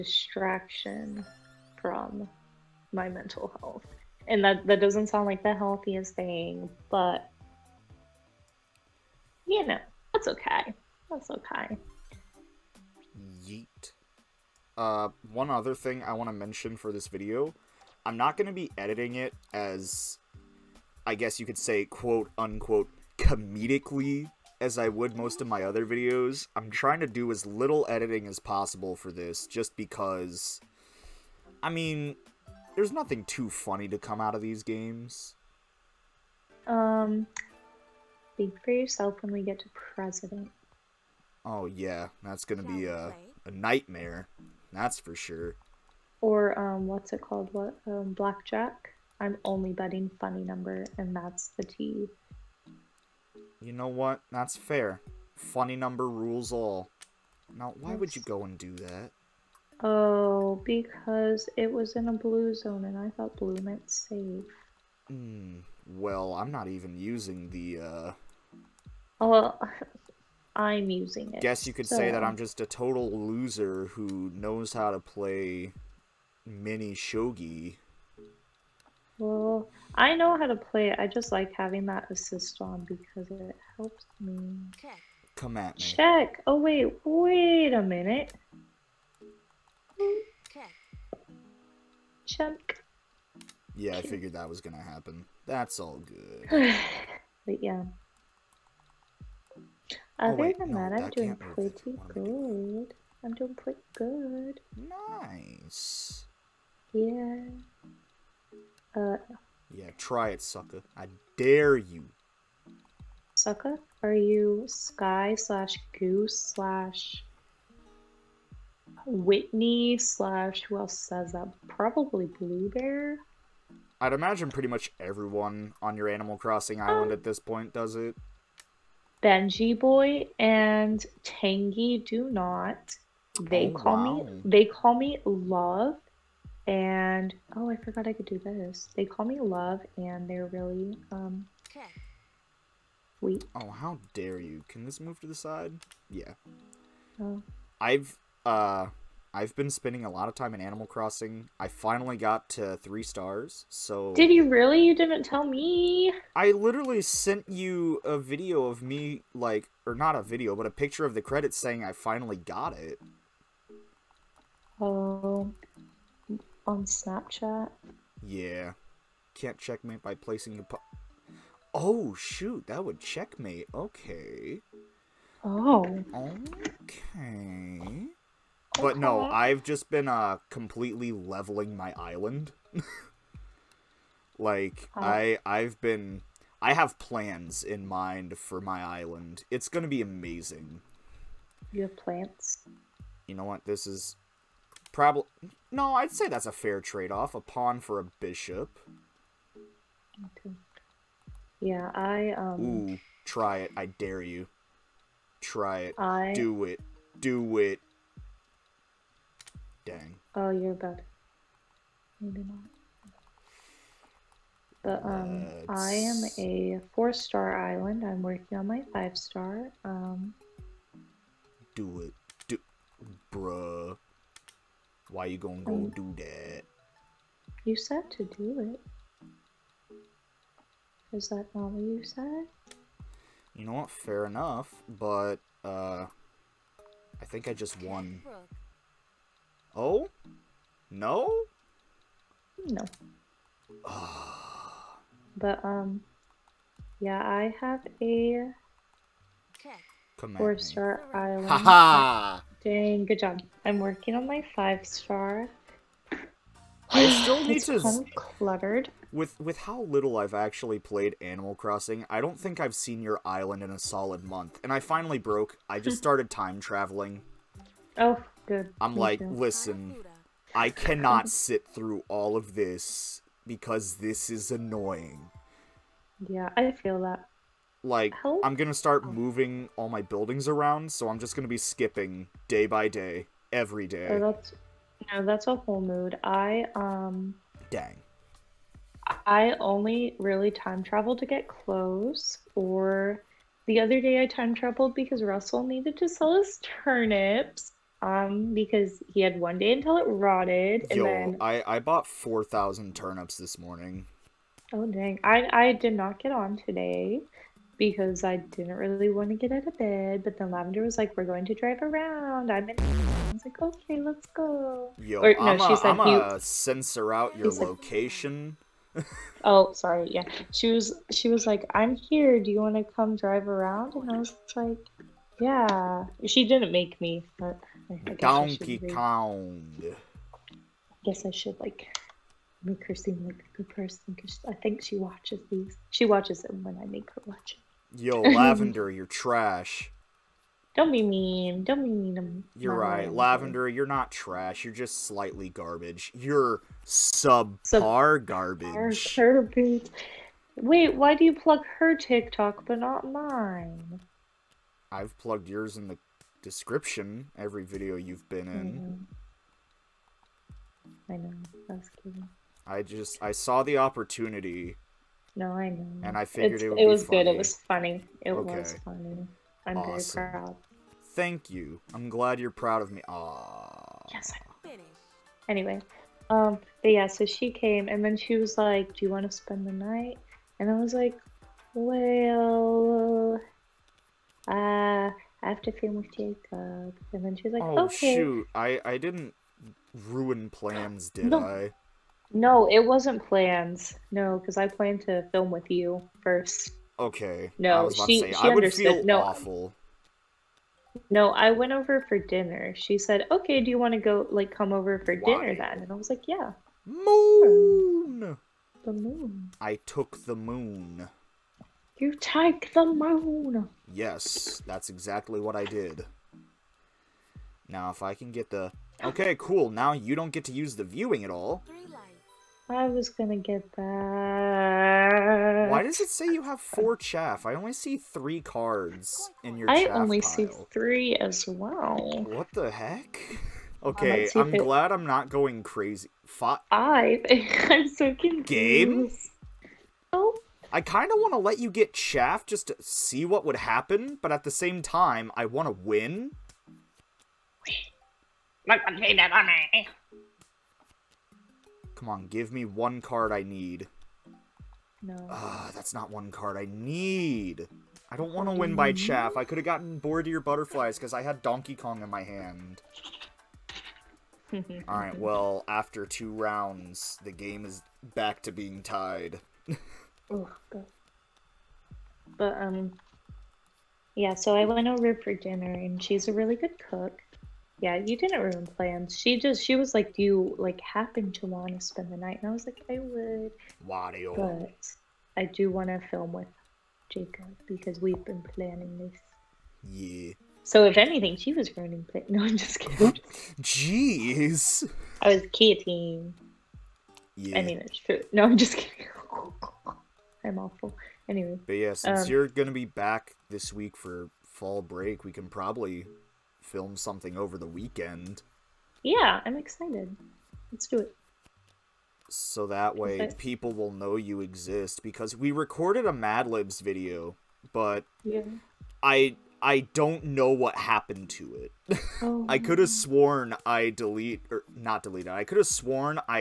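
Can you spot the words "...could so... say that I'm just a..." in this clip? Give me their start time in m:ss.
1:11.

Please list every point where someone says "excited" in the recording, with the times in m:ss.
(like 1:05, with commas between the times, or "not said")
8:29.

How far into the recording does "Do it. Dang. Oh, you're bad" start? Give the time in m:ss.
3:27.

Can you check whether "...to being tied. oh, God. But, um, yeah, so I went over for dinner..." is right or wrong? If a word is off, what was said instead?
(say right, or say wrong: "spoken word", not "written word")
right.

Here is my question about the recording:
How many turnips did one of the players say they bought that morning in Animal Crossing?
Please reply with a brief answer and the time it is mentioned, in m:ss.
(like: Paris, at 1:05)
4000, at 5:02.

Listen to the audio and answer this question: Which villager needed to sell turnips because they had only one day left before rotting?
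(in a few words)
Russell.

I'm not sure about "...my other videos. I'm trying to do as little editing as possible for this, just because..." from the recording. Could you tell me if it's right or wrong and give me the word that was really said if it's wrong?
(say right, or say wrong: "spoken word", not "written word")
right.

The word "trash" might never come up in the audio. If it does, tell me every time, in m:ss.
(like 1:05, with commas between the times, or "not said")
5:39, 5:44.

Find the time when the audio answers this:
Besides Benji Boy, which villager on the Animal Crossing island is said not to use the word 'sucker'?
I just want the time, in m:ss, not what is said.
2:11.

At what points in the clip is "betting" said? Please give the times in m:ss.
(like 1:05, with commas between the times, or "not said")
0:49.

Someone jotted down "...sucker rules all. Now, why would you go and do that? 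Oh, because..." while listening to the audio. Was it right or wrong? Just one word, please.
wrong.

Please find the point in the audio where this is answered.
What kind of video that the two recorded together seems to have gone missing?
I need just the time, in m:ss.
8:36.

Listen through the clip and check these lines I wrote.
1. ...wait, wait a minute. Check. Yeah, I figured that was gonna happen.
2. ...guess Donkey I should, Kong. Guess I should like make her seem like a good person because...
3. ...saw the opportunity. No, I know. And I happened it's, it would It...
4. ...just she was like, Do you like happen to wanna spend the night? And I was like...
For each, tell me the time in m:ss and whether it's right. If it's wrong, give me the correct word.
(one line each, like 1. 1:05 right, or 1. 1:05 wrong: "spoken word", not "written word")
1. 1:26 right
2. 5:28 right
3. 6:03 wrong: "figured", not "happened"
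4. 7:59 right.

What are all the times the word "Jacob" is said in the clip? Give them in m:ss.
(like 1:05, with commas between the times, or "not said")
6:26, 8:07.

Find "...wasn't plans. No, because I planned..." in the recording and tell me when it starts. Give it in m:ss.
6:32.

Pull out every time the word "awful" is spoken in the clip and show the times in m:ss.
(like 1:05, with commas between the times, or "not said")
6:39, 8:20.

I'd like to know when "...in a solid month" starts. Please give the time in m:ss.
4:23.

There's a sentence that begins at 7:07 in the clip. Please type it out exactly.
I only see three cards in your.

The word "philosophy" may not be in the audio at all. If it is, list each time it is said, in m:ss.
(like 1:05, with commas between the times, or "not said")
not said.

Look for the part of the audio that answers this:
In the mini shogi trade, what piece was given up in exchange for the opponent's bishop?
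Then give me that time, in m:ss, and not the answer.
3:17.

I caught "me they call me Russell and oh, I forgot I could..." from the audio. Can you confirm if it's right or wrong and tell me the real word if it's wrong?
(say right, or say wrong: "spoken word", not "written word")
wrong: "Love", not "Russell".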